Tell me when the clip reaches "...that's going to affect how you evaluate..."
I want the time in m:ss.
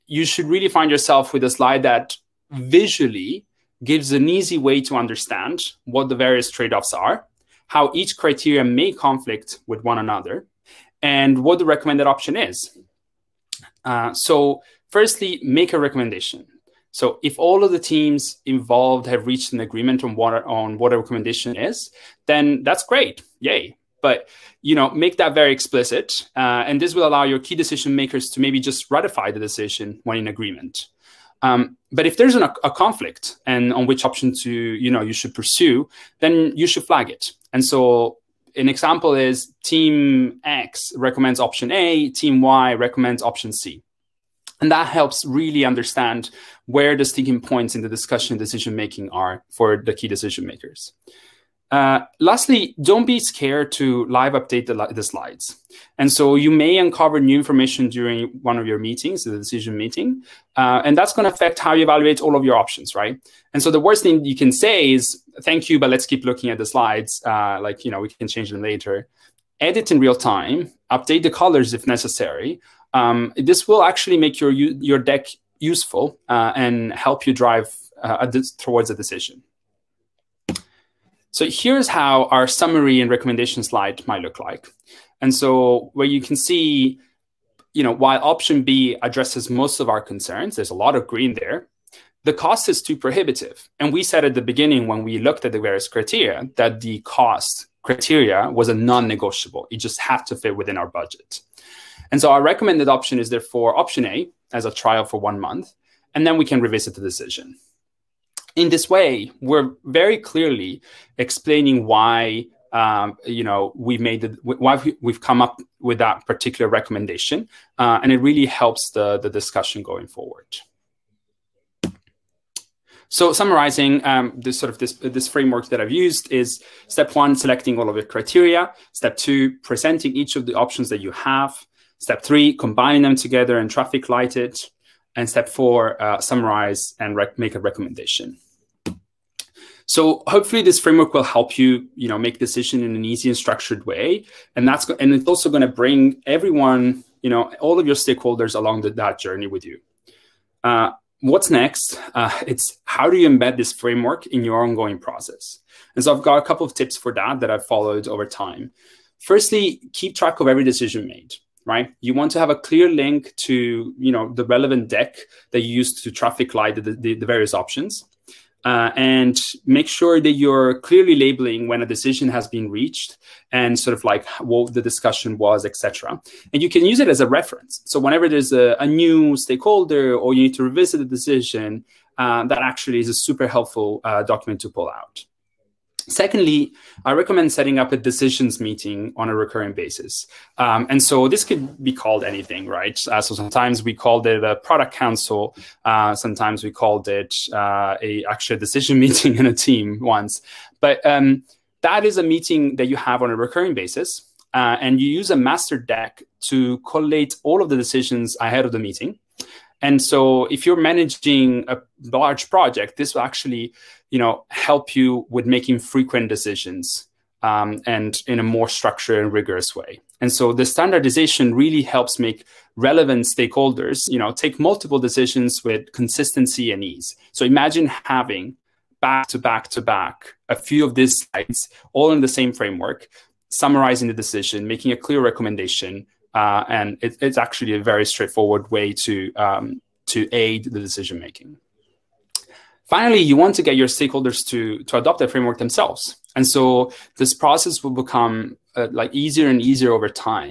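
1:00.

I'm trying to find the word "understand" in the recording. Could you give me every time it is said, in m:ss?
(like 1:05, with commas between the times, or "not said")
0:04, 0:45.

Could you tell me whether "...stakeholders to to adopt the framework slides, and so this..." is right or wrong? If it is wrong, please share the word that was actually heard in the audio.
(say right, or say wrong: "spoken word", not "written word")
wrong: "themselves", not "slides".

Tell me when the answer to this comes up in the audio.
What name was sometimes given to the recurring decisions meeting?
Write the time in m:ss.
3:14.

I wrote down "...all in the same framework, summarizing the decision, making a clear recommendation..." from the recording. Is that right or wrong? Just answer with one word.
right.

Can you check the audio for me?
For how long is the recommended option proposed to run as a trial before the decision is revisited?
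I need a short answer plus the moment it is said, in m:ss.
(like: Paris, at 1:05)
1 month, at 1:45.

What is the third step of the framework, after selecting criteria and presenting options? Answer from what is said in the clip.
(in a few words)
Traffic light it.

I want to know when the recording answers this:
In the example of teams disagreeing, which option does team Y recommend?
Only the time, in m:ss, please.
0:42.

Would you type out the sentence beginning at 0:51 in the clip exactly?
Uh, lastly, don't be scared to live update the, the, slides.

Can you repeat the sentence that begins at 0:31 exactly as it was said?
Um, but if there's an, a conflict and on which option to you know you should pursue, then you should flag it.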